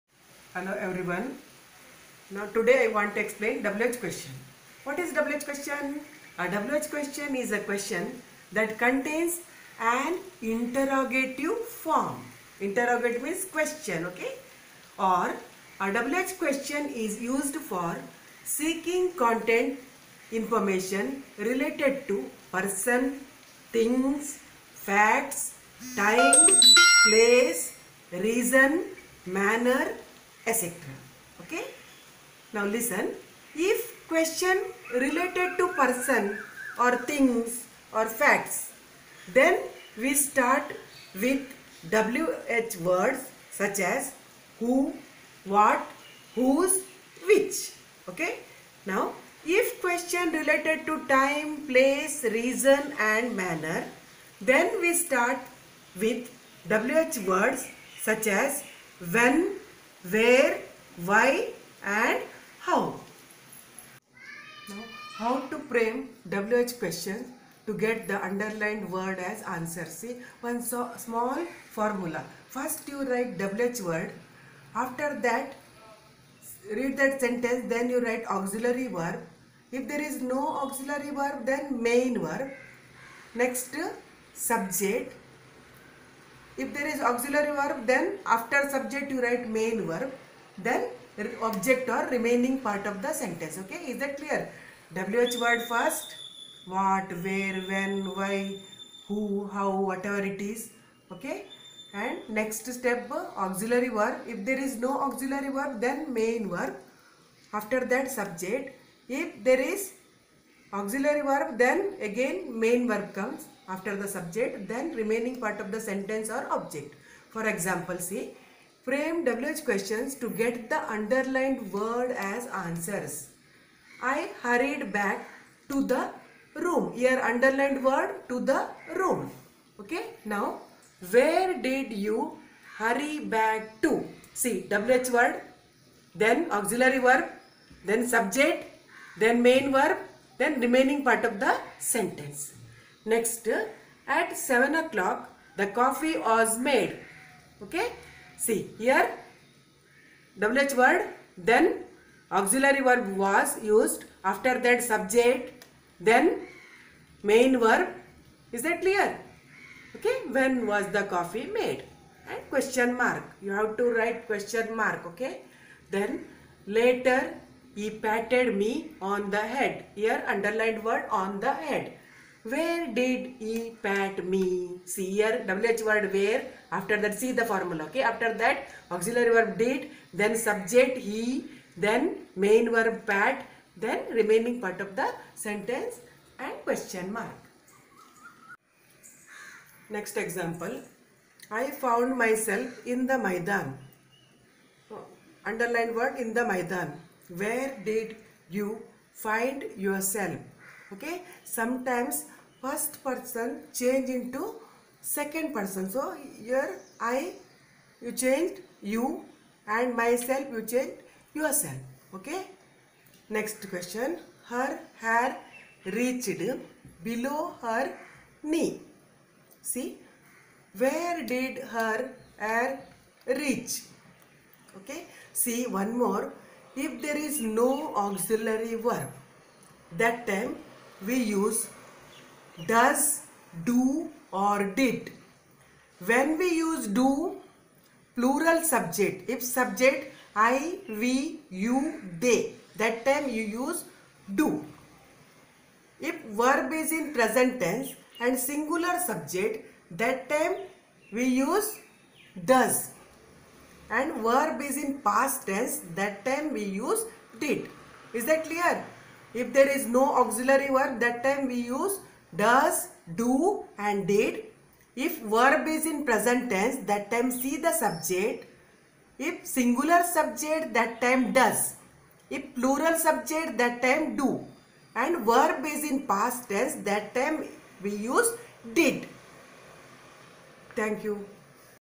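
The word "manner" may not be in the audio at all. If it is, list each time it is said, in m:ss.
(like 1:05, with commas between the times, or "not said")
0:29, 0:53.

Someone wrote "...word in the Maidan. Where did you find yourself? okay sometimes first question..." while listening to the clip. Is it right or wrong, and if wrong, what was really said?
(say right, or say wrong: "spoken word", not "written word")
wrong: "person", not "question".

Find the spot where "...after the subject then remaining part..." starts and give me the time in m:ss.
1:53.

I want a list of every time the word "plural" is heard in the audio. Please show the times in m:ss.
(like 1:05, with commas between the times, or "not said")
3:58, 4:32.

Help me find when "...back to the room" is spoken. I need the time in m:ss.
2:04.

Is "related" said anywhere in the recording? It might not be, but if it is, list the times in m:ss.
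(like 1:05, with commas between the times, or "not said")
0:21, 0:34, 0:50.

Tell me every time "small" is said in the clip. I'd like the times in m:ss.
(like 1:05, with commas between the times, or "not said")
1:10.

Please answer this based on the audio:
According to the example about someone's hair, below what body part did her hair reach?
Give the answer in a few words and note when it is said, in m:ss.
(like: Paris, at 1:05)
her knee, at 3:37.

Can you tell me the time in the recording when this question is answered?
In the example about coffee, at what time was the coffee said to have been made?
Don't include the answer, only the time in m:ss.
2:24.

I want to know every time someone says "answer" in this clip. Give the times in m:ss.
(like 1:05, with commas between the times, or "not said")
1:09, 2:02.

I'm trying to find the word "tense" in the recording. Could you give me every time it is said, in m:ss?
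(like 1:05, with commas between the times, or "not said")
4:07, 4:15, 4:26, 4:36.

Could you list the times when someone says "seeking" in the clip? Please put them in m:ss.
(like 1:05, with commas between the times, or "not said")
0:18.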